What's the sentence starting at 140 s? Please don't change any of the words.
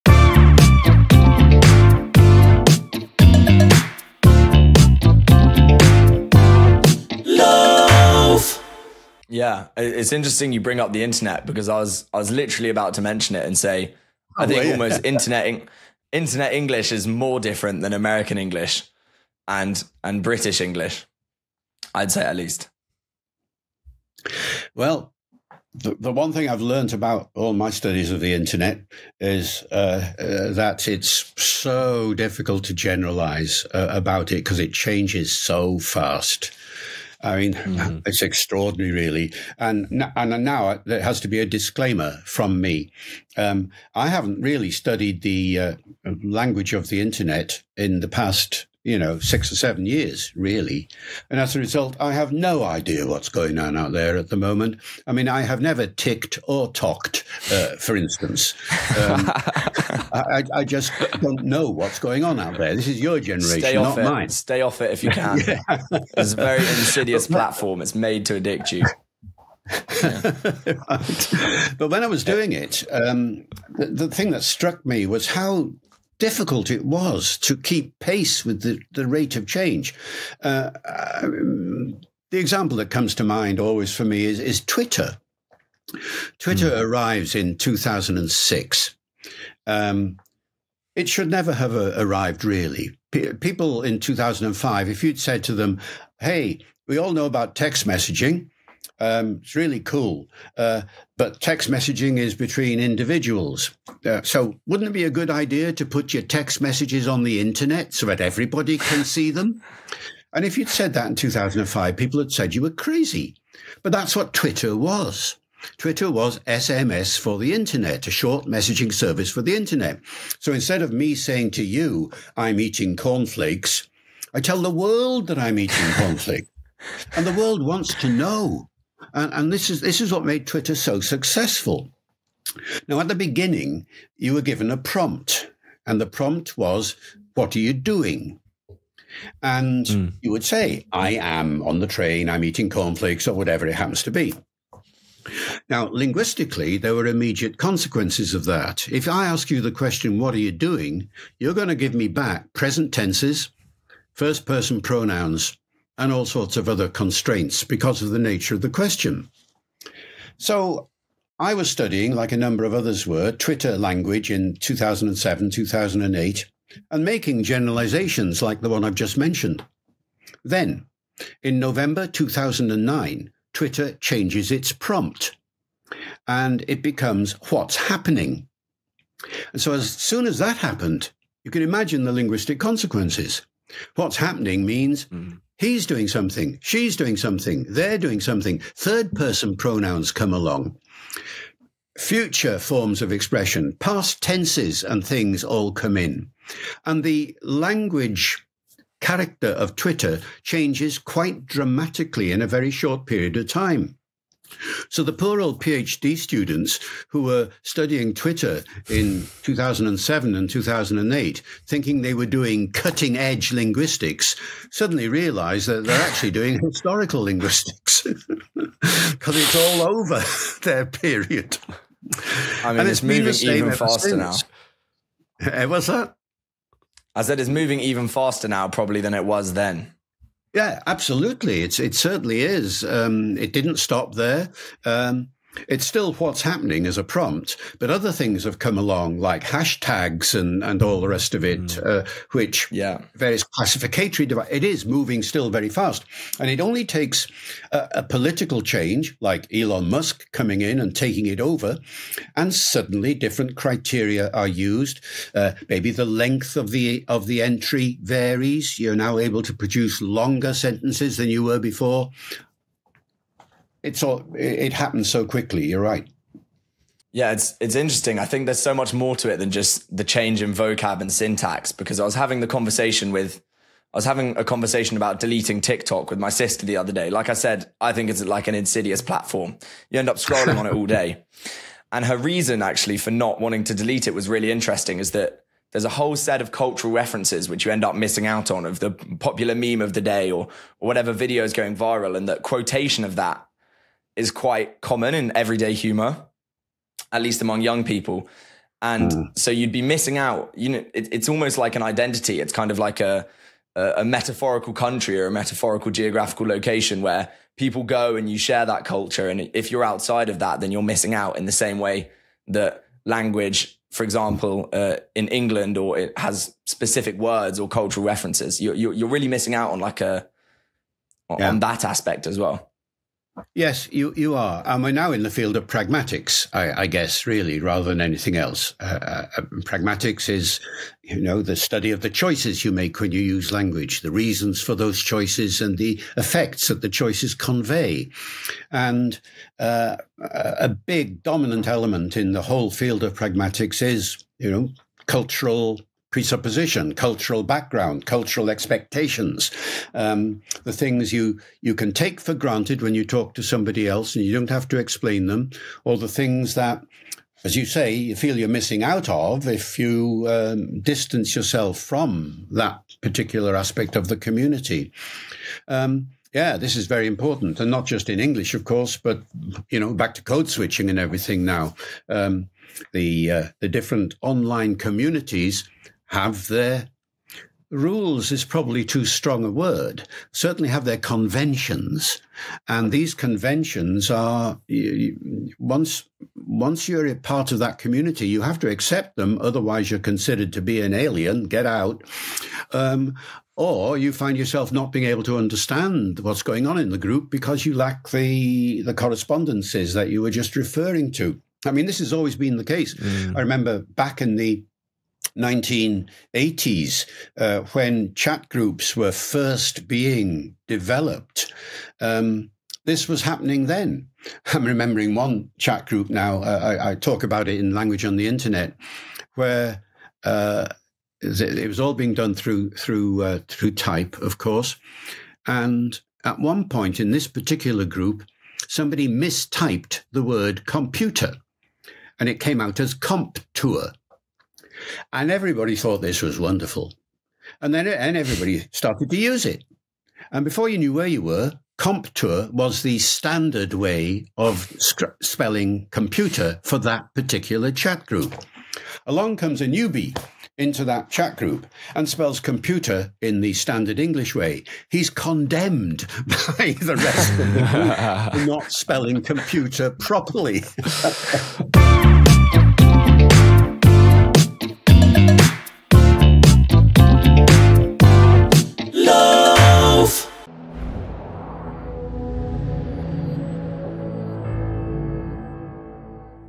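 you would say, I am on the train, I'm eating cornflakes, or whatever it happens to be.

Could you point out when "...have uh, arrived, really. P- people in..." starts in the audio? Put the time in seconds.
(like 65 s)
91 s.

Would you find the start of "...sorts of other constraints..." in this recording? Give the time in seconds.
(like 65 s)
156 s.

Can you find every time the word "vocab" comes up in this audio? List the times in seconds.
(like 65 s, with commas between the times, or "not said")
270 s.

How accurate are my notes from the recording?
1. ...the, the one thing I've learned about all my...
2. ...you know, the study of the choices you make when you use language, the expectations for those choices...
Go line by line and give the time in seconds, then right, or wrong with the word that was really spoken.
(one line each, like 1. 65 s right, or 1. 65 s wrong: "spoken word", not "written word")
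1. 25 s right
2. 331 s wrong: "reasons", not "expectations".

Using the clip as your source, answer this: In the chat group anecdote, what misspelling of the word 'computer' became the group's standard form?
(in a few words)
Comp tour.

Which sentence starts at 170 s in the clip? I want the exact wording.
Then, in November 2009, Twitter changes its prompt and it becomes what's happening.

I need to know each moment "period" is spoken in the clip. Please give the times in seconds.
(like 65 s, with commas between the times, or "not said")
203 s, 220 s.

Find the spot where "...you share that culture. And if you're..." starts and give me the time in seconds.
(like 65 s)
308 s.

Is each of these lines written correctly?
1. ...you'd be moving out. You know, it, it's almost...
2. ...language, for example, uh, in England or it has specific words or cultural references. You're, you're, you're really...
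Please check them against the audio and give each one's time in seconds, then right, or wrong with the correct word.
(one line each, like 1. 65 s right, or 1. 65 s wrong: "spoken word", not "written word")
1. 299 s wrong: "missing", not "moving"
2. 313 s right.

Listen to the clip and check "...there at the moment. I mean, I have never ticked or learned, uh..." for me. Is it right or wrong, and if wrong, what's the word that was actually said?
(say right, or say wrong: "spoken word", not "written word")
wrong: "talked", not "learned".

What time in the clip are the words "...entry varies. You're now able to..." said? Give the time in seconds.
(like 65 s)
257 s.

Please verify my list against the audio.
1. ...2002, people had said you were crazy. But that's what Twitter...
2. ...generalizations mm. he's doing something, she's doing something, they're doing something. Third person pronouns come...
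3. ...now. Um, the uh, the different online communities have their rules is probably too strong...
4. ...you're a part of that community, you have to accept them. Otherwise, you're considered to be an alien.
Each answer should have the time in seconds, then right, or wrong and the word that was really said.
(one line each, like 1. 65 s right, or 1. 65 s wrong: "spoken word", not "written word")
1. 111 s wrong: "2005", not "2002"
2. 184 s wrong: "means", not "generalizations"
3. 371 s right
4. 386 s right.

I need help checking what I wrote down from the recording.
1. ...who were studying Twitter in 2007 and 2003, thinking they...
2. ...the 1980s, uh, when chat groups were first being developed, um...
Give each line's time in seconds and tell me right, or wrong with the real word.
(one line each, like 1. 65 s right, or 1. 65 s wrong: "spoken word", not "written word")
1. 207 s wrong: "2008", not "2003"
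2. 404 s right.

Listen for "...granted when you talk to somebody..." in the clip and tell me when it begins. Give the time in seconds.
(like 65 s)
352 s.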